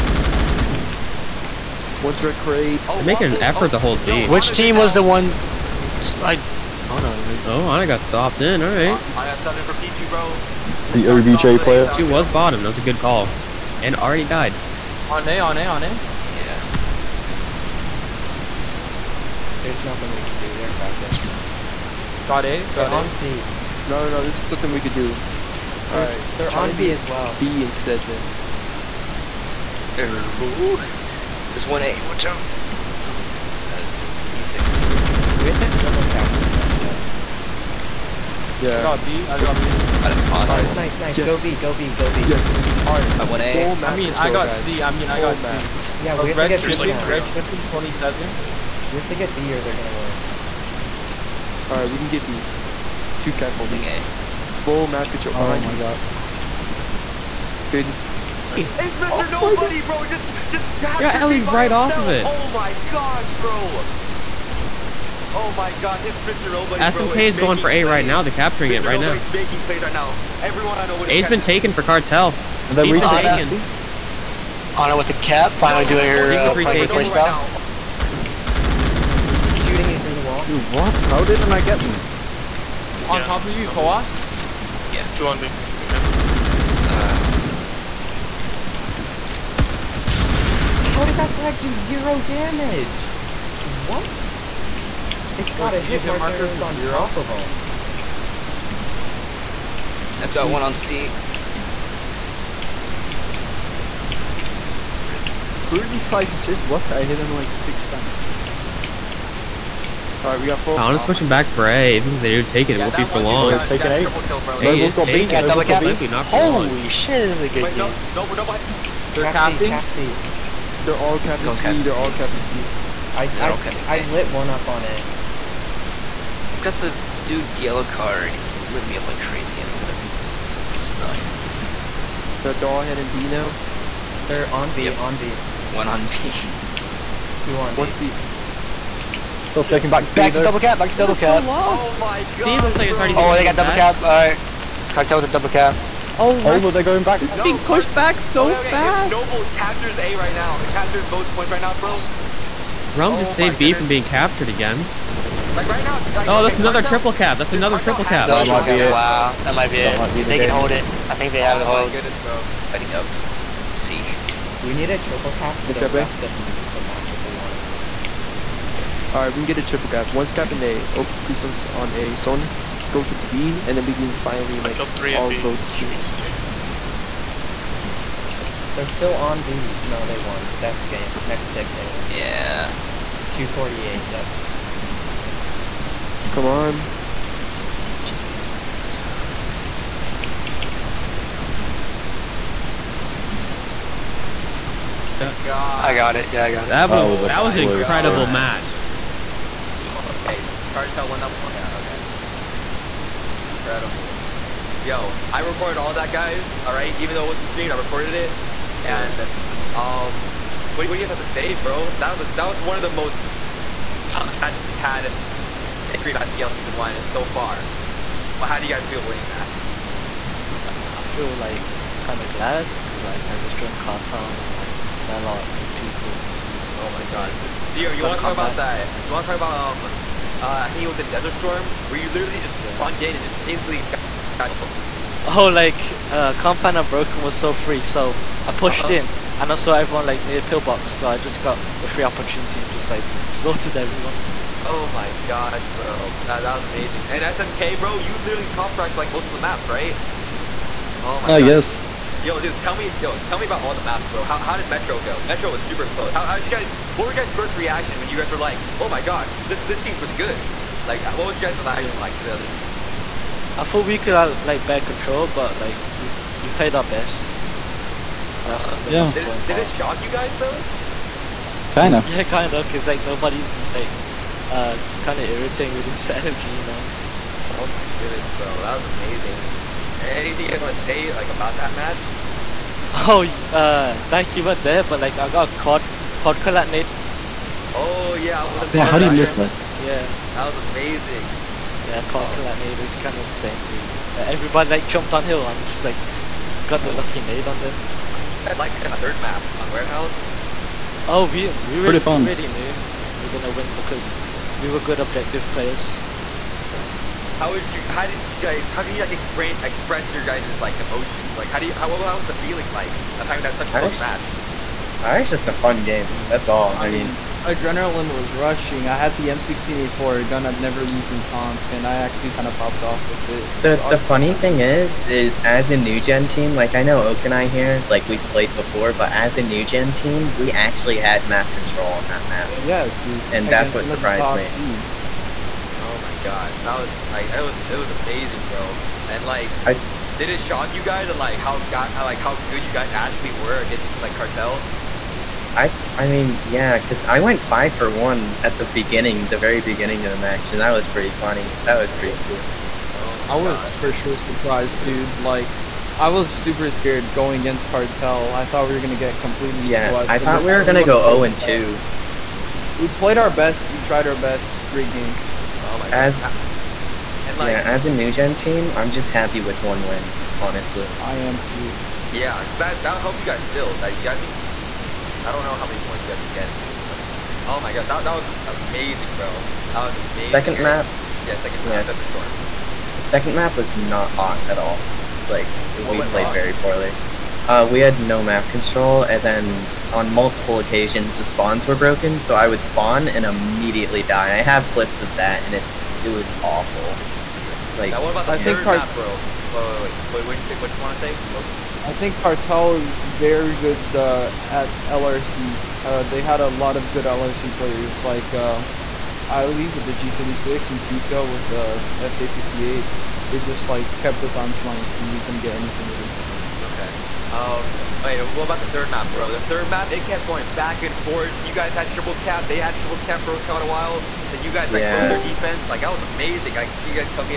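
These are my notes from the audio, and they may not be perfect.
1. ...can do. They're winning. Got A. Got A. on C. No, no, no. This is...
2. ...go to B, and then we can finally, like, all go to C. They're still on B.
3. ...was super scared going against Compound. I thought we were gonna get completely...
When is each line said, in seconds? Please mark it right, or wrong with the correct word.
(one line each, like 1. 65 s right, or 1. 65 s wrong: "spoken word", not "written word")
1. 20 s wrong: "capping", not "winning"
2. 172 s right
3. 356 s wrong: "Cartel", not "Compound".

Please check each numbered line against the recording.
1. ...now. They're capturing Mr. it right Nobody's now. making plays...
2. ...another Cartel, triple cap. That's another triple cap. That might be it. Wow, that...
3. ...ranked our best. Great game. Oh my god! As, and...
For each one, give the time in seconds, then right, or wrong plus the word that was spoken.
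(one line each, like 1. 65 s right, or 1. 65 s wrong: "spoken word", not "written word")
1. 68 s right
2. 156 s right
3. 363 s wrong: "tried", not "ranked".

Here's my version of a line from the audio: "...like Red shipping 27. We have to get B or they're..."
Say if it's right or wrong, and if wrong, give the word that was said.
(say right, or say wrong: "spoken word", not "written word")
right.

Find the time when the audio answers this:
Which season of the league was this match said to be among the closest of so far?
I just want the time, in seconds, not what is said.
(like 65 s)
216 s.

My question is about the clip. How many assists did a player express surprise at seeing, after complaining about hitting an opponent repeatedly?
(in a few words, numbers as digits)
35.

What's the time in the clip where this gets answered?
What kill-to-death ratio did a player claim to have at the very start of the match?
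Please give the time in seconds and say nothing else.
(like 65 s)
347 s.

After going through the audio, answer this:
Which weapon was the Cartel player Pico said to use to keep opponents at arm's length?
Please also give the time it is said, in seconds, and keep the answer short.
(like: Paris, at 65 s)
SA58, at 412 s.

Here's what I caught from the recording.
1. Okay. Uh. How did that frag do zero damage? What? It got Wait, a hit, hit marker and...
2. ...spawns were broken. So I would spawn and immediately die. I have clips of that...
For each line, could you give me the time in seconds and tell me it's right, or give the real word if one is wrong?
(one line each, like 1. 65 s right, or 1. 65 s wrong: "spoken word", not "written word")
1. 85 s right
2. 391 s right.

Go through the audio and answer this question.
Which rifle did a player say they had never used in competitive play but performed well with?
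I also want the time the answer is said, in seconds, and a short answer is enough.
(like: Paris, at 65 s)
M16A4, at 319 s.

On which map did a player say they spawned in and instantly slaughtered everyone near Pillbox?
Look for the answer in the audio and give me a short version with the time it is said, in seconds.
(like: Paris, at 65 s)
Desert Storm, at 231 s.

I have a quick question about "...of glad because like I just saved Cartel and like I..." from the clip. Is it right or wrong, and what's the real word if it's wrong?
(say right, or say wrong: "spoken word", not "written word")
wrong: "joined", not "saved".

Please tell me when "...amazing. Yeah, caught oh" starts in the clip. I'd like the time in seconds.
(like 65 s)
290 s.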